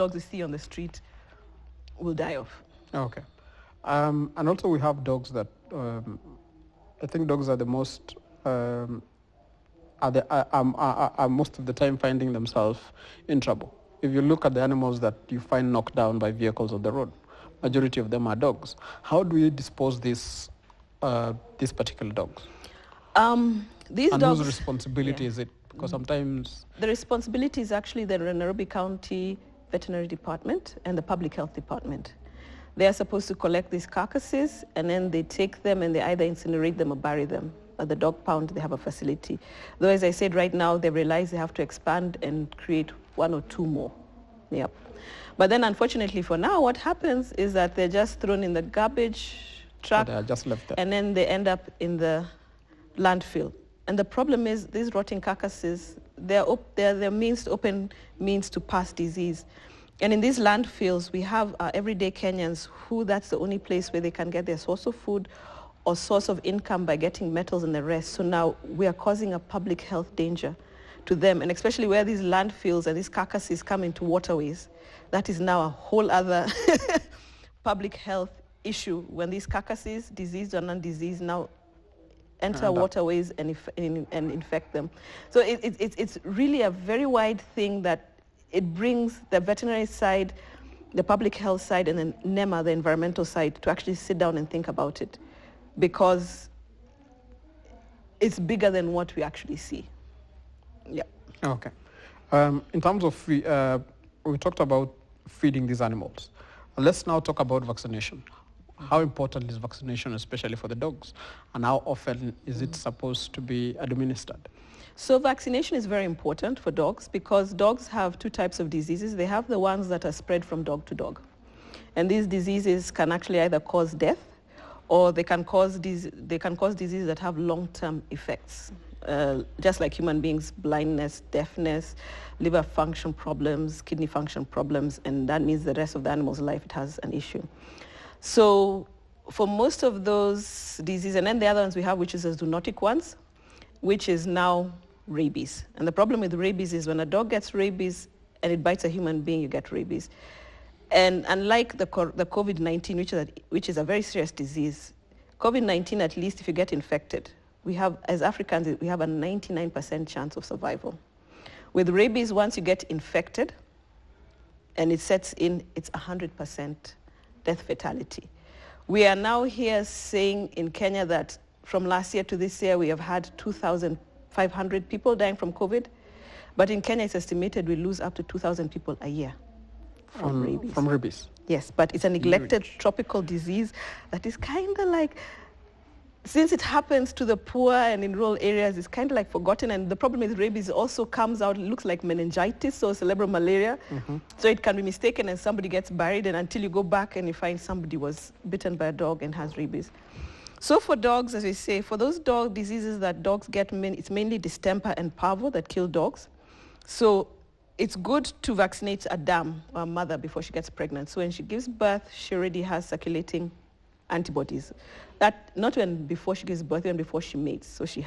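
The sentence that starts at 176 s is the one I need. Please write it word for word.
But in Kenya, it's estimated we lose up to 2,000 people a year from um, rabies.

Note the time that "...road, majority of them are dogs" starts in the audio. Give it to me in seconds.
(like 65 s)
16 s.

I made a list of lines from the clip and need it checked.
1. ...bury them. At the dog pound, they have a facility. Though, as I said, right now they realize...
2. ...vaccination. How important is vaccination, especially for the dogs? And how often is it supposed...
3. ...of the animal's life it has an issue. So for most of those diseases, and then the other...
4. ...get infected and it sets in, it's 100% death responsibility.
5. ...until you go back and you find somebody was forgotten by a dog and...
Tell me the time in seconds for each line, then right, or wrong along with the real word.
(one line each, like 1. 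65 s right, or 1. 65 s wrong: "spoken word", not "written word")
1. 36 s right
2. 107 s right
3. 135 s right
4. 162 s wrong: "fatality", not "responsibility"
5. 196 s wrong: "bitten", not "forgotten".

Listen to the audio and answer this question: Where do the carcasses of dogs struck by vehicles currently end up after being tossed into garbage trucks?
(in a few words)
Landfill.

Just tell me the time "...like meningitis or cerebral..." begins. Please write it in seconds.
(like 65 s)
191 s.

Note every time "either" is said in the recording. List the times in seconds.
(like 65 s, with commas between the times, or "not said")
36 s, 123 s.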